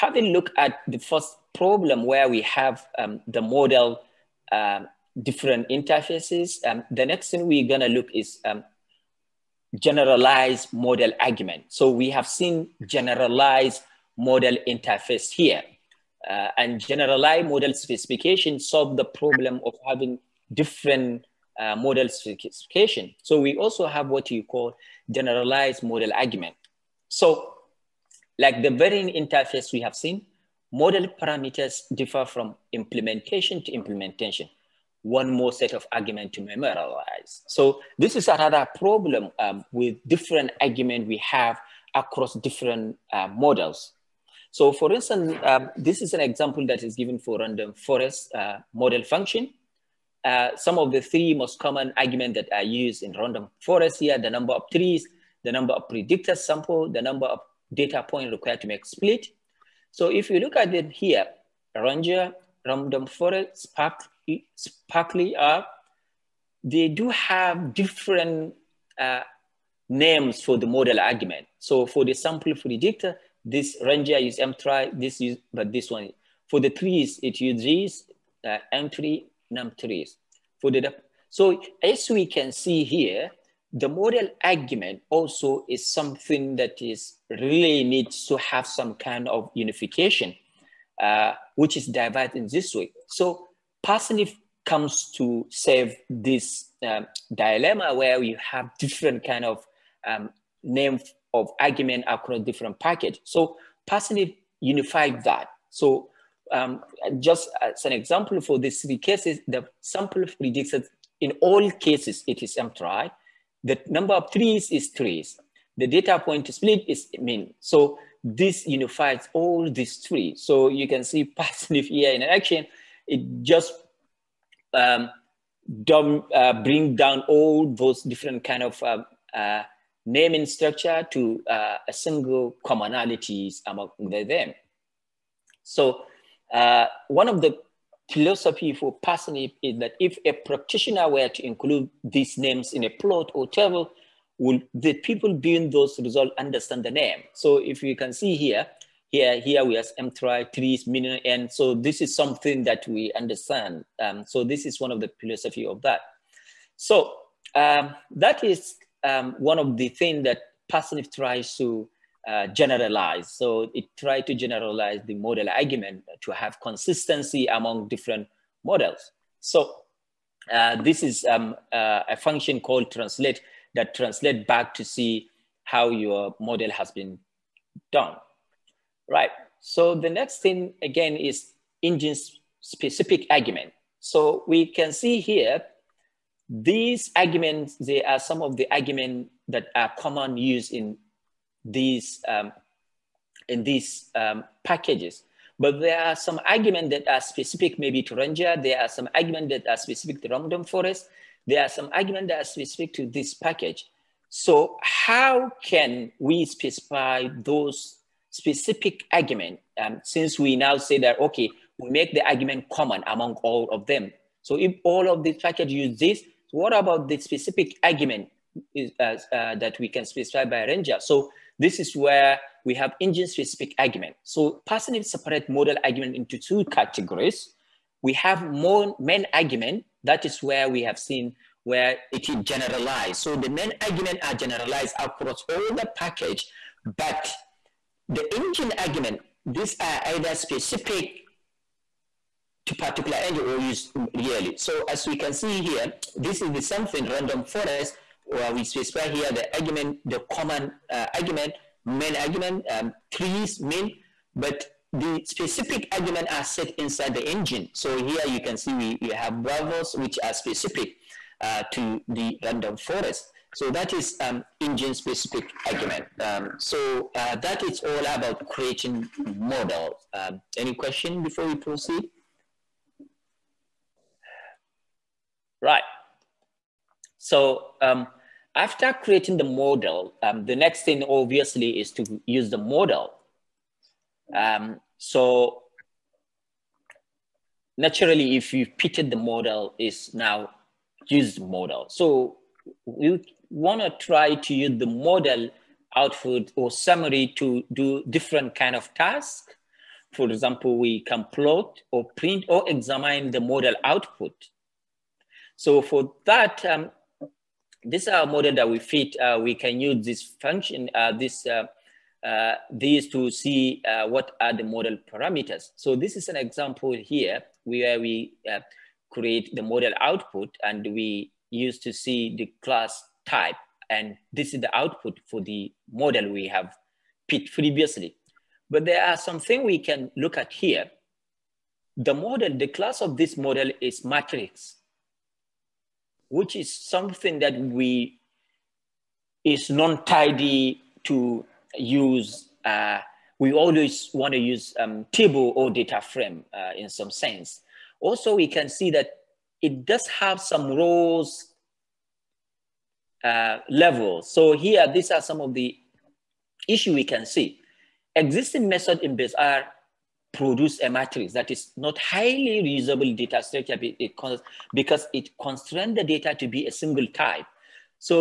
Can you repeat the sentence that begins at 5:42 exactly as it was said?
Uh, we always want to use um, table or data frame uh, in some sense.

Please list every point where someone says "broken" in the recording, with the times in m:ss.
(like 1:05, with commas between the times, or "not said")
not said.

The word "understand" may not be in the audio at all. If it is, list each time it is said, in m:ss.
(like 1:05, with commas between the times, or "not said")
2:26, 2:33.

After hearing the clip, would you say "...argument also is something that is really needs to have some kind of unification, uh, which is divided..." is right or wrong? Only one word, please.
right.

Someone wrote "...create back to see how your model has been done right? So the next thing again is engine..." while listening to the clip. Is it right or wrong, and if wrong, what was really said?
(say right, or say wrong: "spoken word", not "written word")
wrong: "translate", not "create".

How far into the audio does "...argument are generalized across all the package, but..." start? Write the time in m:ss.
3:53.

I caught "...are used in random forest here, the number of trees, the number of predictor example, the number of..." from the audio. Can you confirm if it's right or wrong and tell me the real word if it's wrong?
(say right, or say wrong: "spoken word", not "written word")
wrong: "sample", not "example".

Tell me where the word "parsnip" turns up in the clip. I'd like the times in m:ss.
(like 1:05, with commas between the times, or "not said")
1:33, 1:43, 2:01, 2:19.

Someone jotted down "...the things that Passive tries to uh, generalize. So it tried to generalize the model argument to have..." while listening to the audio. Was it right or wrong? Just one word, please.
right.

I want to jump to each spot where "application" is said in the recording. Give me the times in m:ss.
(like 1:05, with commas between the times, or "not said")
not said.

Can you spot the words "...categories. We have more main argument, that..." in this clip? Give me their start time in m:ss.
3:46.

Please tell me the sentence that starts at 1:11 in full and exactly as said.
So for the sample predictor, this ranger is mtry, this is, but this one.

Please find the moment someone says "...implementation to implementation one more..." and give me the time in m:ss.
0:32.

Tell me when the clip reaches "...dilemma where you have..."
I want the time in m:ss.
1:37.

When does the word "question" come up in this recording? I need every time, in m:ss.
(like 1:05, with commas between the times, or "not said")
4:30.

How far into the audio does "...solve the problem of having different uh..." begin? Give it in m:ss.
0:18.